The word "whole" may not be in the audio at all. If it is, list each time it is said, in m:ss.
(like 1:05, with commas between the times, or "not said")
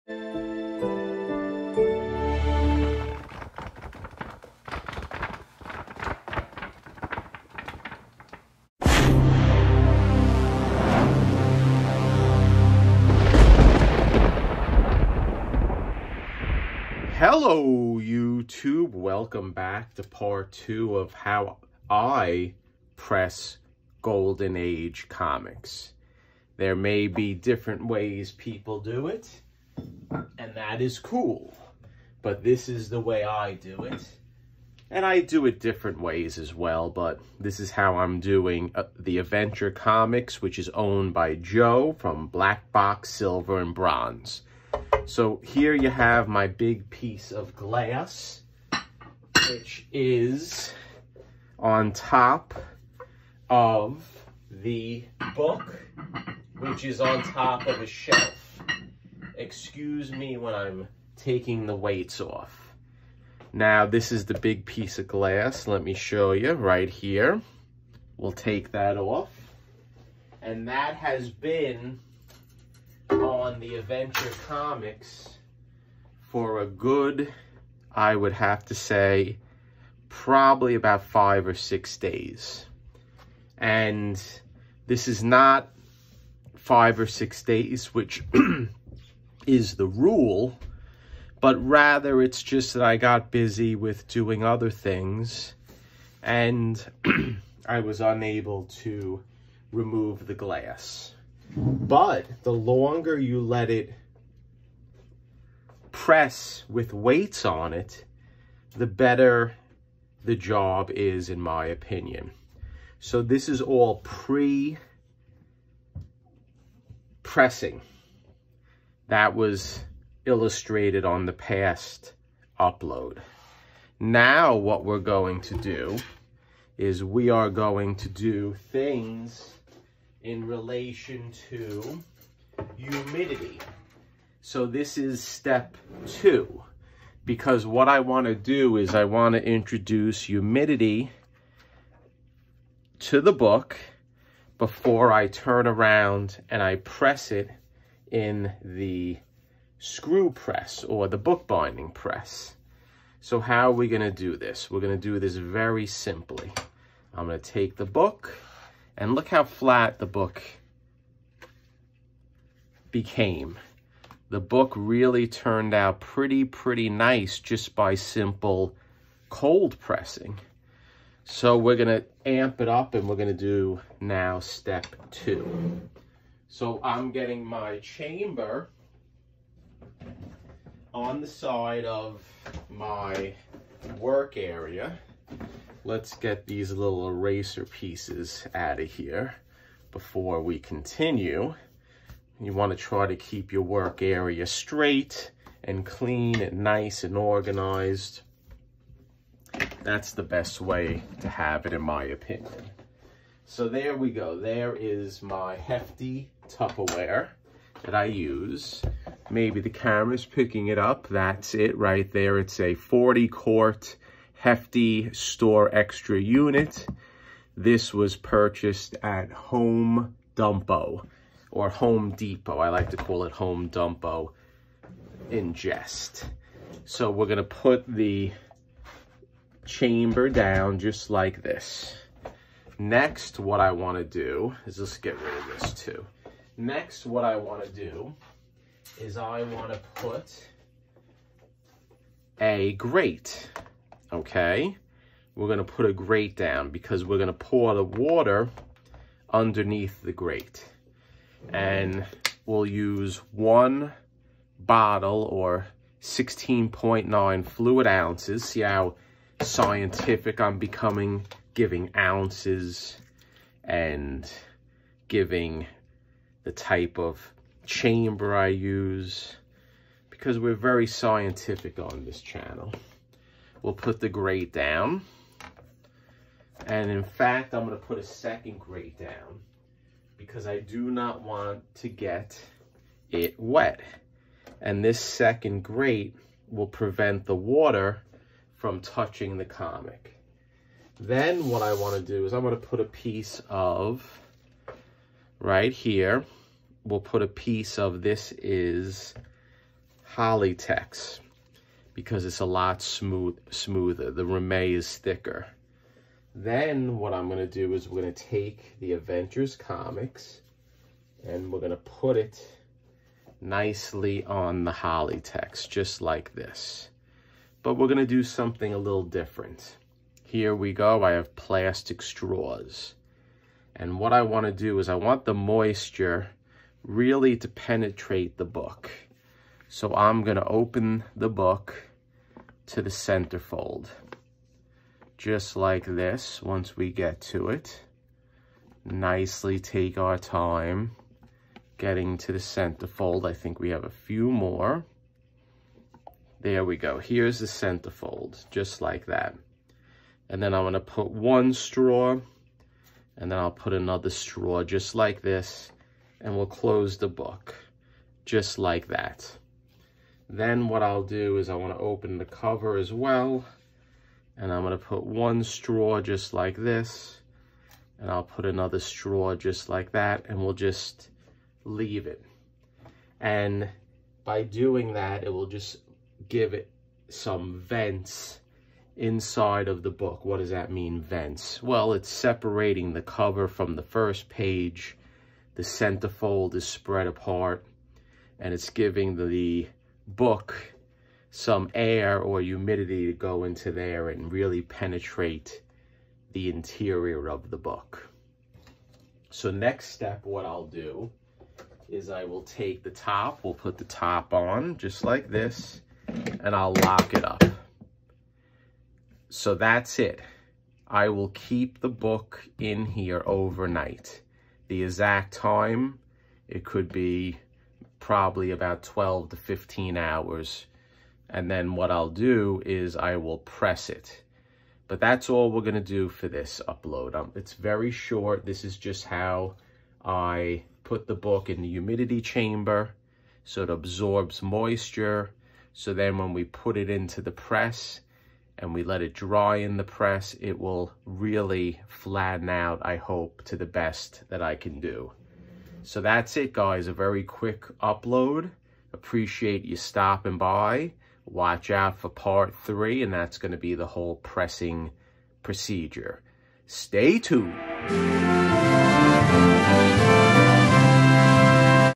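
7:33.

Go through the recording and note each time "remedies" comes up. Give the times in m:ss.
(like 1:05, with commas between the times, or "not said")
not said.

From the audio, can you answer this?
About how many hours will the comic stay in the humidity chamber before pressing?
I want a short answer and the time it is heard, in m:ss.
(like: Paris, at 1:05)
12 to 15 hours, at 6:58.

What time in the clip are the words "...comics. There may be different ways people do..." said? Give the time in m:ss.
0:25.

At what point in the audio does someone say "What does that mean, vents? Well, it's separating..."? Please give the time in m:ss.
6:20.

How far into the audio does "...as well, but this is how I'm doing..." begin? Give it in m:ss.
0:36.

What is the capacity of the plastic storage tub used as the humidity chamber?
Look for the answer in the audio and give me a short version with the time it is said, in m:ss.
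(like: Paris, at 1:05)
40 quart, at 3:32.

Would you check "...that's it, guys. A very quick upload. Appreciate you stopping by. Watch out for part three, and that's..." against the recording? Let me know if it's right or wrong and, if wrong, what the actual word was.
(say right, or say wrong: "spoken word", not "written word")
right.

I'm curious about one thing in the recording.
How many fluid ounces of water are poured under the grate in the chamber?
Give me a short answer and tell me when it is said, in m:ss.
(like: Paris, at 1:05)
16.9, at 4:16.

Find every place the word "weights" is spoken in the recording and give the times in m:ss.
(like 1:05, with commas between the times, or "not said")
1:01, 1:46.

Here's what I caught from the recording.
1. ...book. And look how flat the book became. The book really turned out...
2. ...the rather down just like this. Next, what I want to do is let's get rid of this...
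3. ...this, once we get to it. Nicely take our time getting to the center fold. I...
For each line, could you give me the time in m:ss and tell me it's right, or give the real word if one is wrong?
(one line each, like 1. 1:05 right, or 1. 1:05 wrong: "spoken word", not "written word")
1. 2:37 right
2. 3:47 wrong: "chamber", not "rather"
3. 5:35 right.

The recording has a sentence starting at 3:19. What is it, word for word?
That's the best way to have it, in my opinion.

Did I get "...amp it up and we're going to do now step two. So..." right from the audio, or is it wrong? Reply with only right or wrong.
right.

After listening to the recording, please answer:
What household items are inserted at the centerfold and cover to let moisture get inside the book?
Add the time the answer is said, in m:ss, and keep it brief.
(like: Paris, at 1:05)
Plastic straws, at 5:21.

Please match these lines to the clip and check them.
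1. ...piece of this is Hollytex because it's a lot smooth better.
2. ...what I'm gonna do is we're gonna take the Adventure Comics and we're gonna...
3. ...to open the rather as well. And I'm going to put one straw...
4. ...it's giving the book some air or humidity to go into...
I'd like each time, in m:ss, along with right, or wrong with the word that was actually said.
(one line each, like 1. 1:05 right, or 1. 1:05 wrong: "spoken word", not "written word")
1. 4:57 wrong: "smoother", not "better"
2. 5:06 right
3. 6:01 wrong: "cover", not "rather"
4. 6:28 right.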